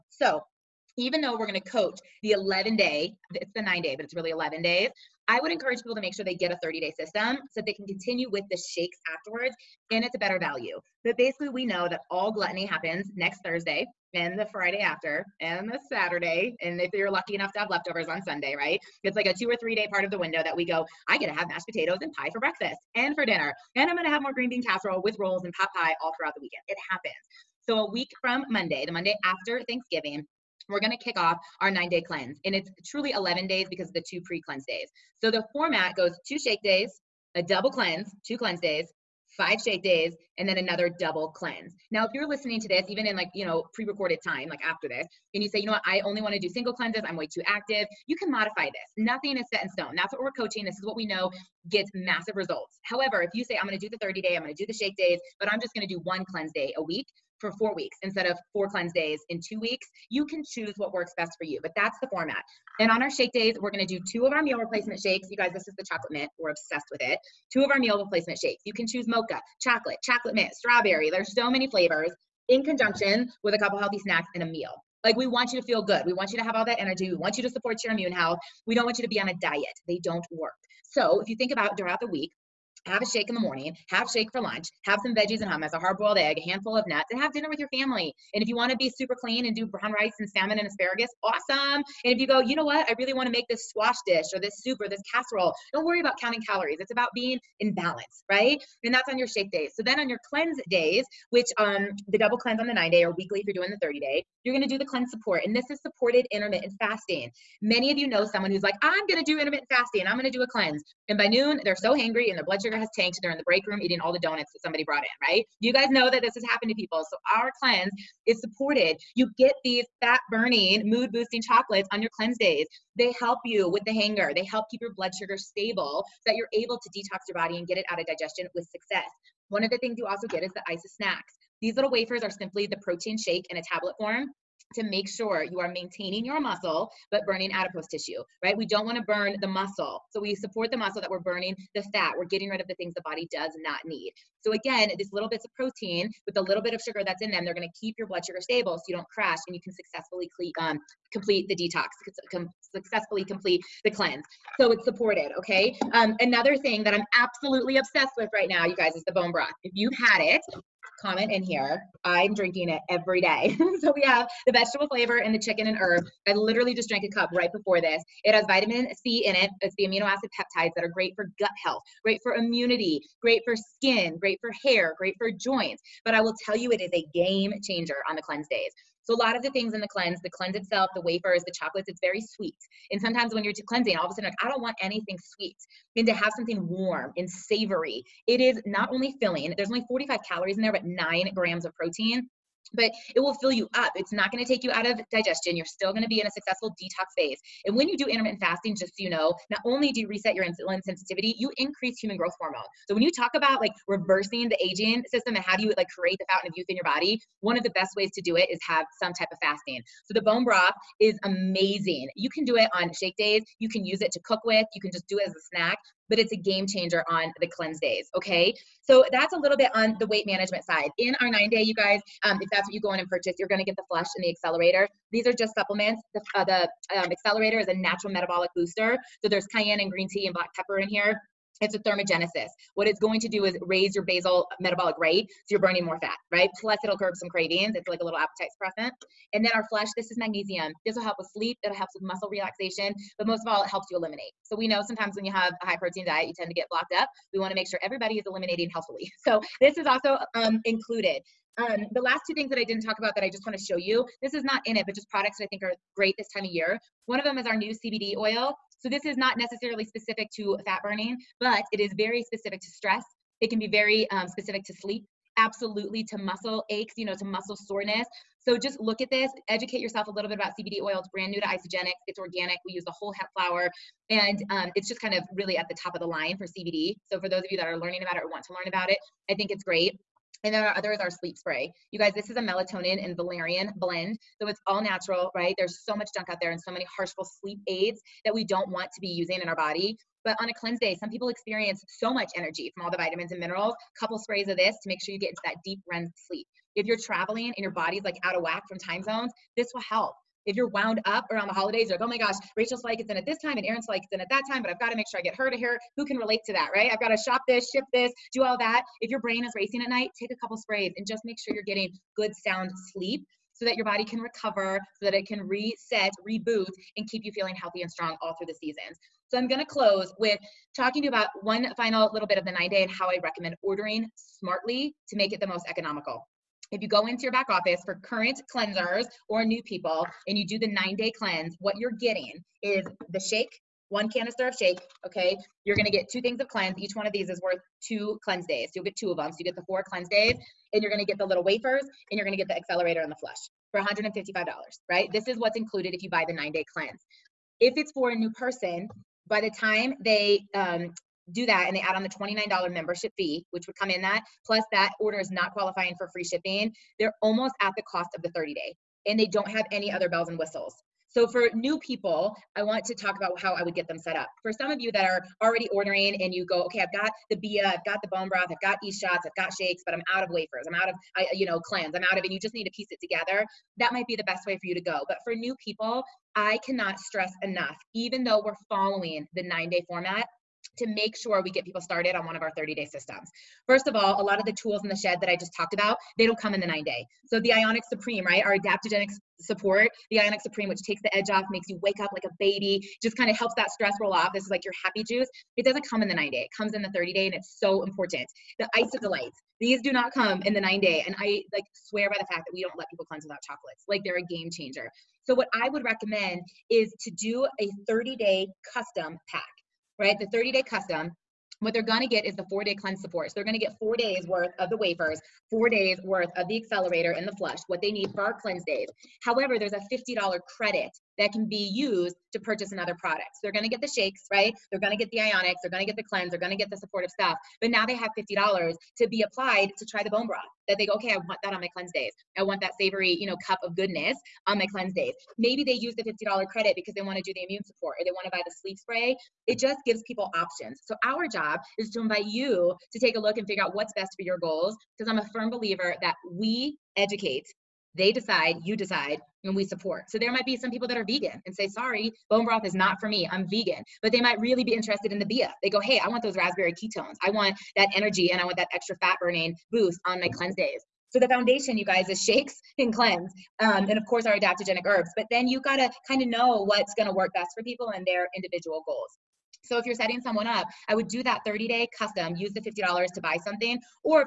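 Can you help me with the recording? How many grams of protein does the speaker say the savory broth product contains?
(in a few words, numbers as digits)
9.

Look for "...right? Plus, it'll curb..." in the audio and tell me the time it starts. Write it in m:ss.
3:56.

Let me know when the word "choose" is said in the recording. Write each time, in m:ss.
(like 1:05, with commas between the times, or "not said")
1:00, 1:08.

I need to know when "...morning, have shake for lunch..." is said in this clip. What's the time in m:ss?
1:23.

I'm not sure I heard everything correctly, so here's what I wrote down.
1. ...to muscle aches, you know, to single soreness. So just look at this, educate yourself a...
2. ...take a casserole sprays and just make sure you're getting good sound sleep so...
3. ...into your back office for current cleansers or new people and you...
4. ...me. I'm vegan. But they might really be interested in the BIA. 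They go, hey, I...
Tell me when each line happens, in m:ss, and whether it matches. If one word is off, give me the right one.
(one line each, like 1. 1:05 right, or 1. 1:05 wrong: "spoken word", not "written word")
1. 4:26 wrong: "muscle", not "single"
2. 5:10 wrong: "couple", not "casserole"
3. 5:27 right
4. 7:33 right.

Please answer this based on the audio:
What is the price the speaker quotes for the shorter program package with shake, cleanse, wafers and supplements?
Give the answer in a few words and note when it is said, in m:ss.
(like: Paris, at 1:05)
$155, at 5:43.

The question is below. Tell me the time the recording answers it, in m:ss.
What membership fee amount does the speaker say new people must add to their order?
5:52.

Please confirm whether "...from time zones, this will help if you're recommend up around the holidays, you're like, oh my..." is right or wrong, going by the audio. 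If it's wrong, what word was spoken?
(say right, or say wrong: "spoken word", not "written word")
wrong: "wound", not "recommend".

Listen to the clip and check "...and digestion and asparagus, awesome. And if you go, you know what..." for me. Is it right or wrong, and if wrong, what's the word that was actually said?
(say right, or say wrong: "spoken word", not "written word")
wrong: "salmon", not "digestion".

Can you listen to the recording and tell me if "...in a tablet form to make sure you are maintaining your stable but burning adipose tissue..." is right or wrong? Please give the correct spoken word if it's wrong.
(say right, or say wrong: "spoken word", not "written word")
wrong: "muscle", not "stable".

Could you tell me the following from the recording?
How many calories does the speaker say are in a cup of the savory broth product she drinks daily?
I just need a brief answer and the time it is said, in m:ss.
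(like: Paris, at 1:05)
45, at 3:09.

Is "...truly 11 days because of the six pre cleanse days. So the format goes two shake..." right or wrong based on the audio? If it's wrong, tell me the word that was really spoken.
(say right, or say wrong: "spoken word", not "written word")
wrong: "two", not "six".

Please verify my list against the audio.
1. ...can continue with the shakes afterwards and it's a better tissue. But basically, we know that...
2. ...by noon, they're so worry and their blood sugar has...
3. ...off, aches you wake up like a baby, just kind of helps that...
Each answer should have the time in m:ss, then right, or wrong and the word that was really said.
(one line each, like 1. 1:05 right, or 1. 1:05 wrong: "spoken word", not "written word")
1. 0:07 wrong: "value", not "tissue"
2. 1:51 wrong: "hangry", not "worry"
3. 6:31 wrong: "makes", not "aches".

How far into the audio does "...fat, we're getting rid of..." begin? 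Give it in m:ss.
2:21.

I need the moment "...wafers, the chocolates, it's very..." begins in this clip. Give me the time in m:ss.
3:00.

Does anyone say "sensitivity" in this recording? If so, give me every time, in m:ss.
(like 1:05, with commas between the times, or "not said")
3:20.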